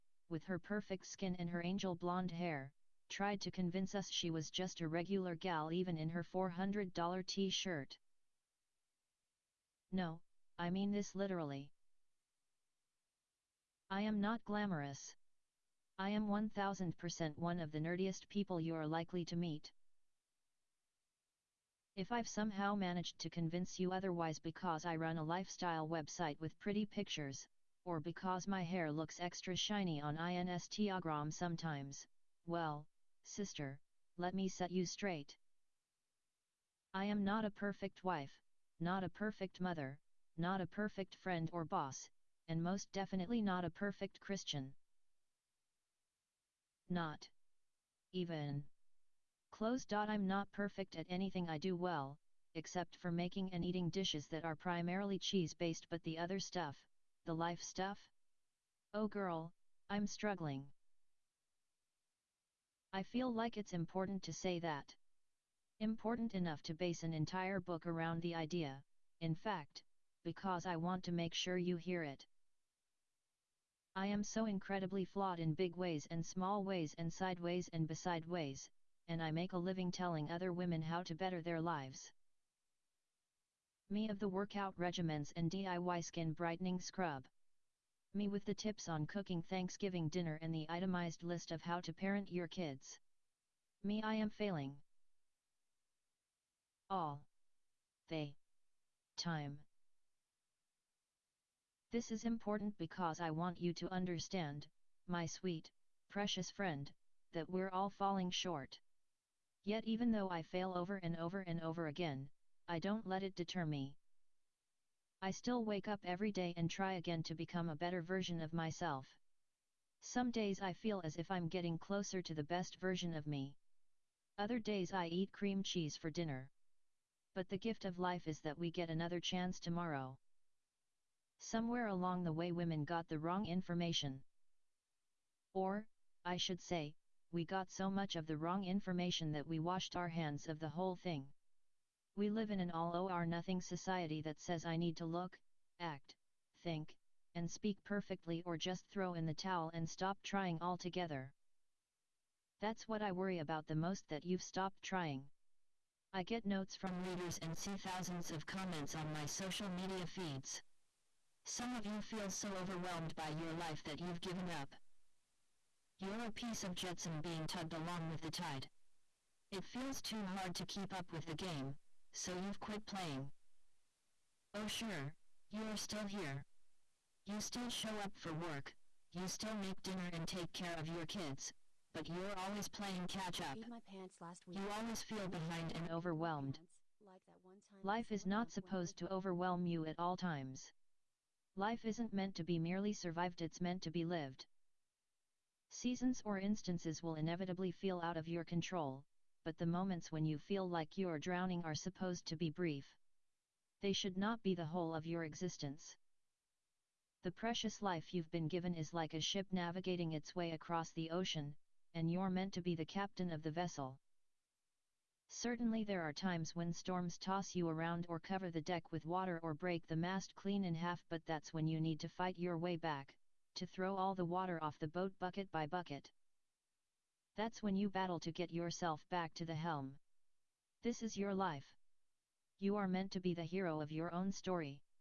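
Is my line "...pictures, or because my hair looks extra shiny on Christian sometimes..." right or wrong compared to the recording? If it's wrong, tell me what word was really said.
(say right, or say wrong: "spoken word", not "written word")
wrong: "Instagram", not "Christian".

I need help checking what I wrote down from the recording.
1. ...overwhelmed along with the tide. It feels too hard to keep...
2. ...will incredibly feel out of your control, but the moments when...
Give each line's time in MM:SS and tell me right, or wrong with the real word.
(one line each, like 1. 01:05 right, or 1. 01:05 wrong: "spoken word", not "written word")
1. 02:47 wrong: "tugged", not "overwhelmed"
2. 03:17 wrong: "inevitably", not "incredibly".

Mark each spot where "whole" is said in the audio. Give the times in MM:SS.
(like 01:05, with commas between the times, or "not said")
02:20, 03:24.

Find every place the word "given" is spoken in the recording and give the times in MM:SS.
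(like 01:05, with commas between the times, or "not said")
02:44, 03:28.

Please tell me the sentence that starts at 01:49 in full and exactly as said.
Yet even though I fail over and over and over again, I don't let it deter me.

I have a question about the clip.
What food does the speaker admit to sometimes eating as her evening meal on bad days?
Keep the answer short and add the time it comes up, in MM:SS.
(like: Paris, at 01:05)
cream cheese, at 02:05.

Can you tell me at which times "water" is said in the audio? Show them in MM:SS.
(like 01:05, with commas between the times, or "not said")
03:39, 03:44.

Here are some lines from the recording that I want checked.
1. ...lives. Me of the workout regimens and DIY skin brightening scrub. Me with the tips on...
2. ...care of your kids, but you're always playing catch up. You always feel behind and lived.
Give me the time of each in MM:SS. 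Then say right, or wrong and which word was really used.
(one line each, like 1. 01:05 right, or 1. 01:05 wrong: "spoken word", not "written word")
1. 01:21 right
2. 03:00 wrong: "overwhelmed", not "lived".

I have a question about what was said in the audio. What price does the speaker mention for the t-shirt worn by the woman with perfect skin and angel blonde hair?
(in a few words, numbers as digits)
$400.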